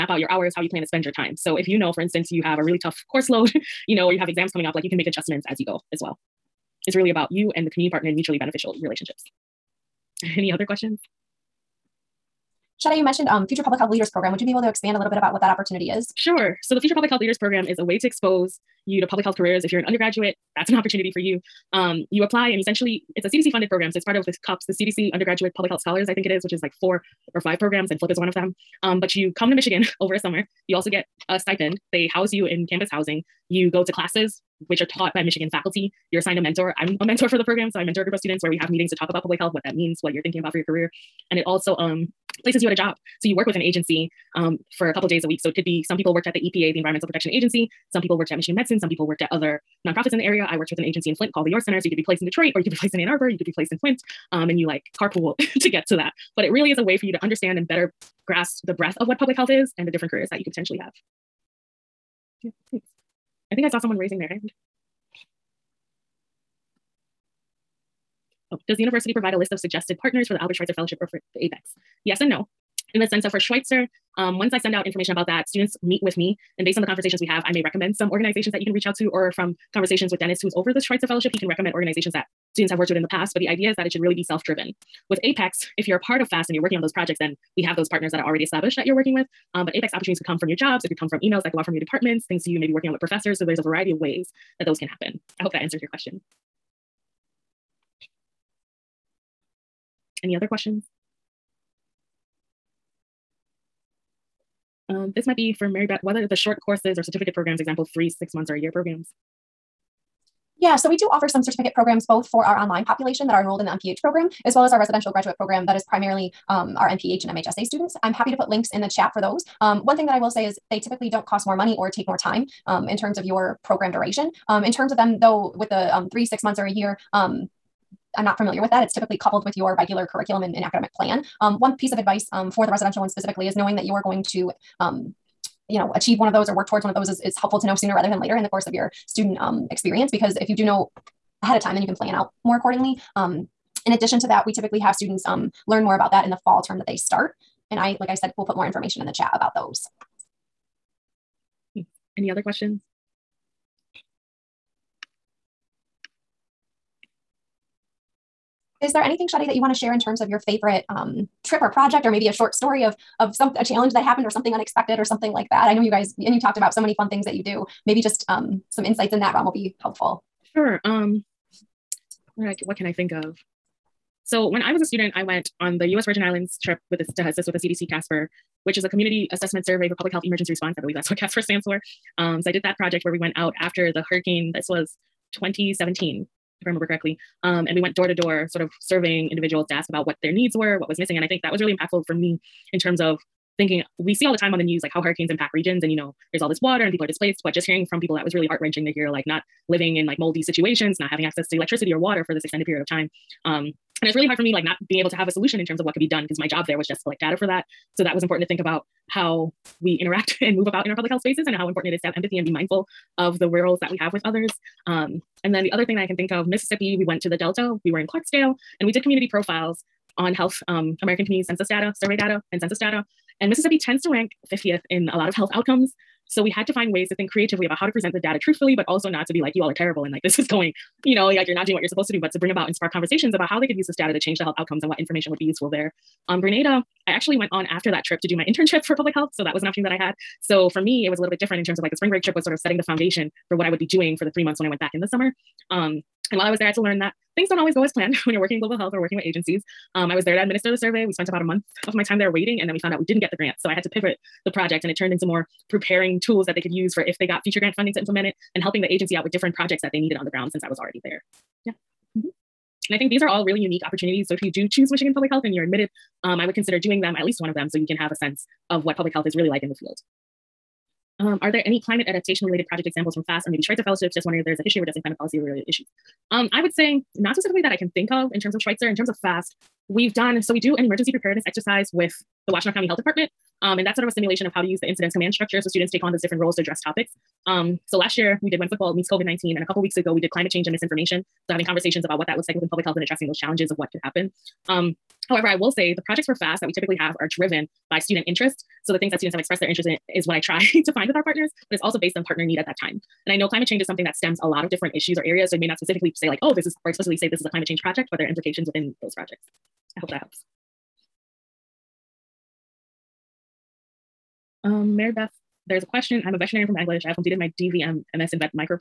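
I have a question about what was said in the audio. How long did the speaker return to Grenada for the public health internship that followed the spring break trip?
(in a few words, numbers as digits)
3 months.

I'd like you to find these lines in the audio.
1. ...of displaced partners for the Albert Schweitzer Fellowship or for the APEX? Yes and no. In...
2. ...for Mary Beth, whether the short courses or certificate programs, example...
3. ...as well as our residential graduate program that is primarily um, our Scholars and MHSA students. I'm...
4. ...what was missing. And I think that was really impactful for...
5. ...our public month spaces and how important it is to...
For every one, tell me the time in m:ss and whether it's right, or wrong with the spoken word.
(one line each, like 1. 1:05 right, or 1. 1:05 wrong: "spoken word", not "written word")
1. 1:09 wrong: "suggested", not "displaced"
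2. 1:45 right
3. 1:54 wrong: "MPH", not "Scholars"
4. 3:10 right
5. 3:30 wrong: "health", not "month".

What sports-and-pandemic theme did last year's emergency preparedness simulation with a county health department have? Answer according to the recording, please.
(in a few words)
when football meets COVID-19.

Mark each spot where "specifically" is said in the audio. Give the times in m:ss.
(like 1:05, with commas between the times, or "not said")
2:13, 4:37, 5:05.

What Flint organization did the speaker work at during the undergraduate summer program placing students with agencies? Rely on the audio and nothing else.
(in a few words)
the Your Center.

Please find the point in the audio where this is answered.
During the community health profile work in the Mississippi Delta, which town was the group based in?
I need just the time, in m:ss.
3:38.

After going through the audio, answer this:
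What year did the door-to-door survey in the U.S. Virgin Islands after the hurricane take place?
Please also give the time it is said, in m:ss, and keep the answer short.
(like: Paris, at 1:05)
2017, at 3:05.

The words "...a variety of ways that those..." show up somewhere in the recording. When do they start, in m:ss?
1:33.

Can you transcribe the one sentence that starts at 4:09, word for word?
Um, I was there to administer the survey.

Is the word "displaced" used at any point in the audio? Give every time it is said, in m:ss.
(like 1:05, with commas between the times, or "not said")
3:17.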